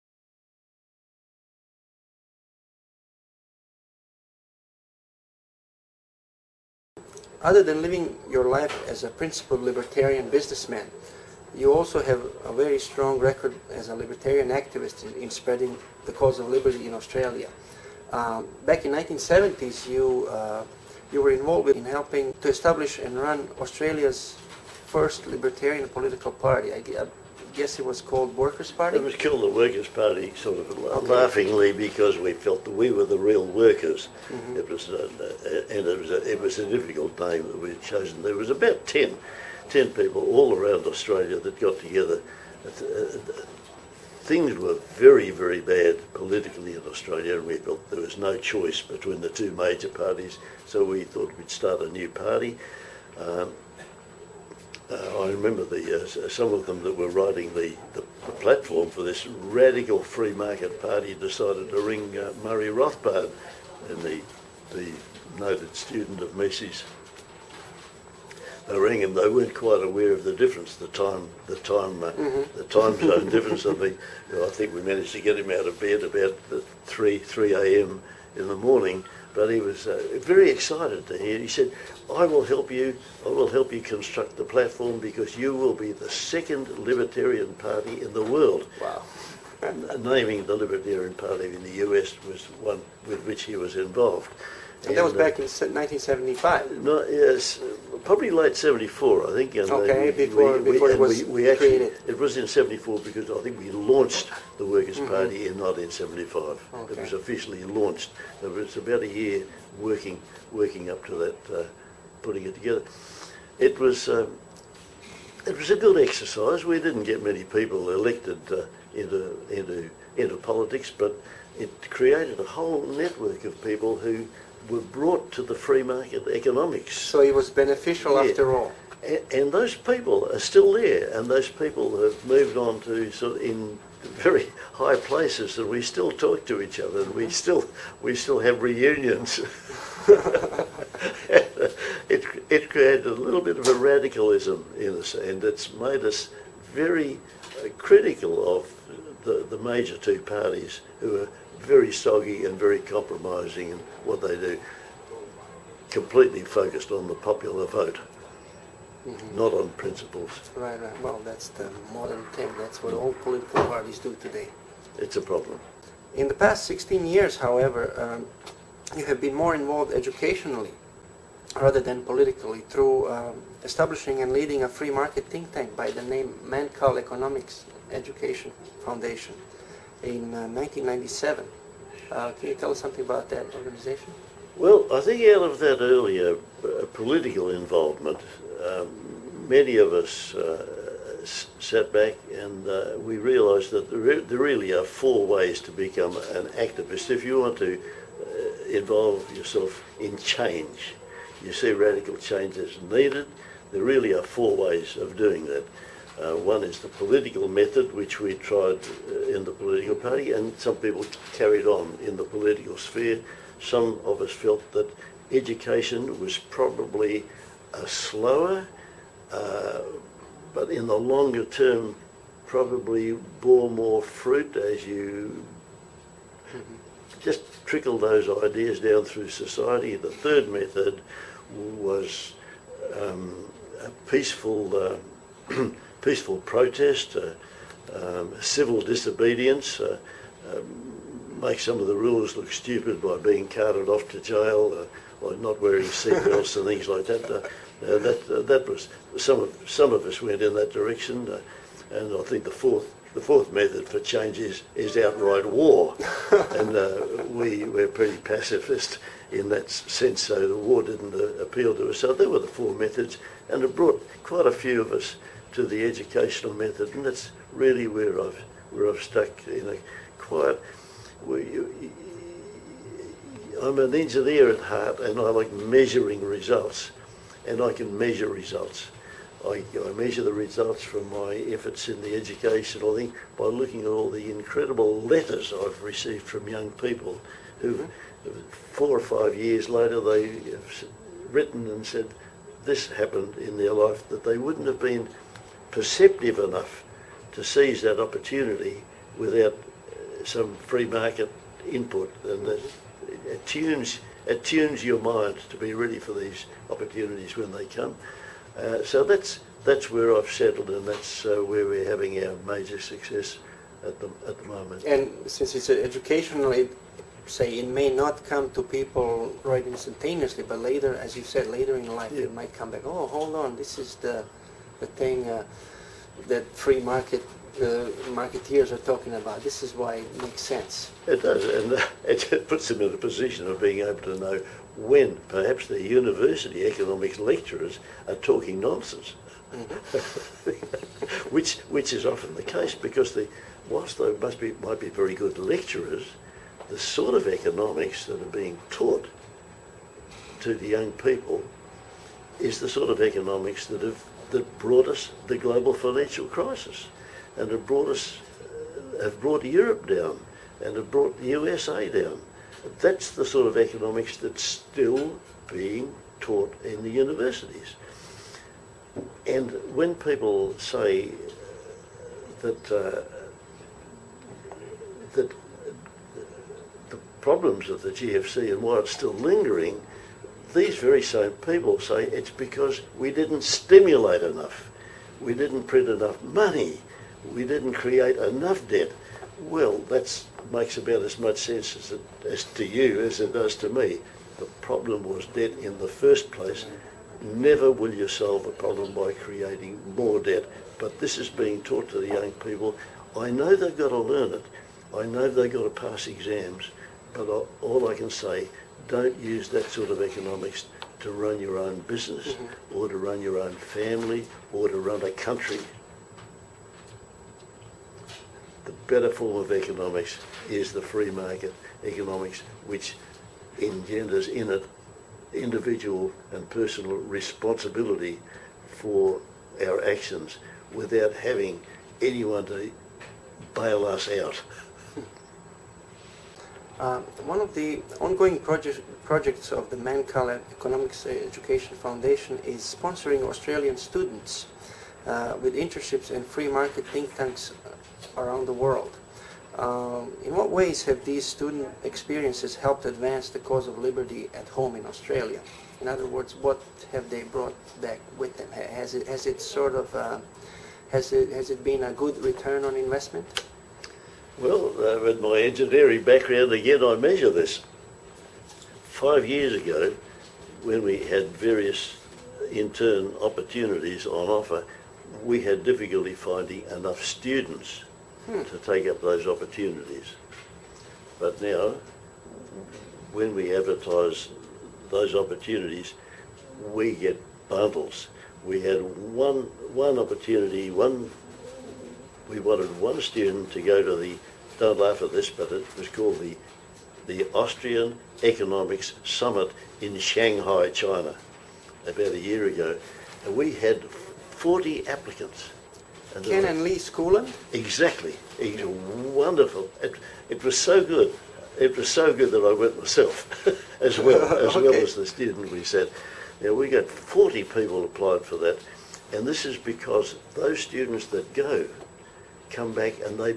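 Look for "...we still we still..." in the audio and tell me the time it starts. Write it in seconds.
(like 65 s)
137 s.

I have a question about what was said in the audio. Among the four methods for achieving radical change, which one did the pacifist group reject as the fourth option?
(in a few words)
Outright war.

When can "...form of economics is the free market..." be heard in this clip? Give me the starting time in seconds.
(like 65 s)
419 s.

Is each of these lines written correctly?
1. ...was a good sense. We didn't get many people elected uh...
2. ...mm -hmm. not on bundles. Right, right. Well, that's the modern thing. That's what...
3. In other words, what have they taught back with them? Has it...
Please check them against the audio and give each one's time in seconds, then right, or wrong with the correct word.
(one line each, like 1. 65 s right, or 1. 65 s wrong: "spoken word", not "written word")
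1. 115 s wrong: "exercise", not "sense"
2. 159 s wrong: "principles", not "bundles"
3. 455 s wrong: "brought", not "taught".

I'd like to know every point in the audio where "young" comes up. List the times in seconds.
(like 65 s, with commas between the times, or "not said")
286 s, 350 s, 402 s.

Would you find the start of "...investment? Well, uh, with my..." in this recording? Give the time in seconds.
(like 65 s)
462 s.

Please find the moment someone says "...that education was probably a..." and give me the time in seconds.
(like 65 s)
214 s.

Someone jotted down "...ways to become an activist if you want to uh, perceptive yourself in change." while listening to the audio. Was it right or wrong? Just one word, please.
wrong.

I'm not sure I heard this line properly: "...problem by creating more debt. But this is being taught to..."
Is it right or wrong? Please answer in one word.
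right.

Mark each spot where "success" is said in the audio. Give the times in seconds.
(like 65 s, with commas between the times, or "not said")
312 s.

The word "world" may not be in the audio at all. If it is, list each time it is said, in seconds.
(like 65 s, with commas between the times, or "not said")
88 s, 448 s.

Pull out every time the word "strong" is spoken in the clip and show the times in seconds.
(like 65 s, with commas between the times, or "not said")
12 s.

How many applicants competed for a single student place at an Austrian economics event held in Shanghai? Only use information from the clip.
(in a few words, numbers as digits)
40.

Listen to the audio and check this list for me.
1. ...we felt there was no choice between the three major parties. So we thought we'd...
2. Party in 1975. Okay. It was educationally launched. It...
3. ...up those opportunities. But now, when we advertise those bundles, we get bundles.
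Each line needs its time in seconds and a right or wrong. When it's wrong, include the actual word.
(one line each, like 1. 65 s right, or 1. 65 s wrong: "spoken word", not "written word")
1. 47 s wrong: "two", not "three"
2. 105 s wrong: "officially", not "educationally"
3. 478 s wrong: "opportunities", not "bundles".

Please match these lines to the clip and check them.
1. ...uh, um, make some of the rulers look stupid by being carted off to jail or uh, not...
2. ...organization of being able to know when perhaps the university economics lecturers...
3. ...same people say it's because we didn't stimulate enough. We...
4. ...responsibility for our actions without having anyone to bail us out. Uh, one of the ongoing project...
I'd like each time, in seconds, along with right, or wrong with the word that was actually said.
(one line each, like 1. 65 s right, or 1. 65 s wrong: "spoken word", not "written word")
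1. 239 s right
2. 332 s wrong: "position", not "organization"
3. 381 s right
4. 427 s right.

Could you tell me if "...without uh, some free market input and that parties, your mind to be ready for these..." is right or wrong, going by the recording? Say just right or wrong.
wrong.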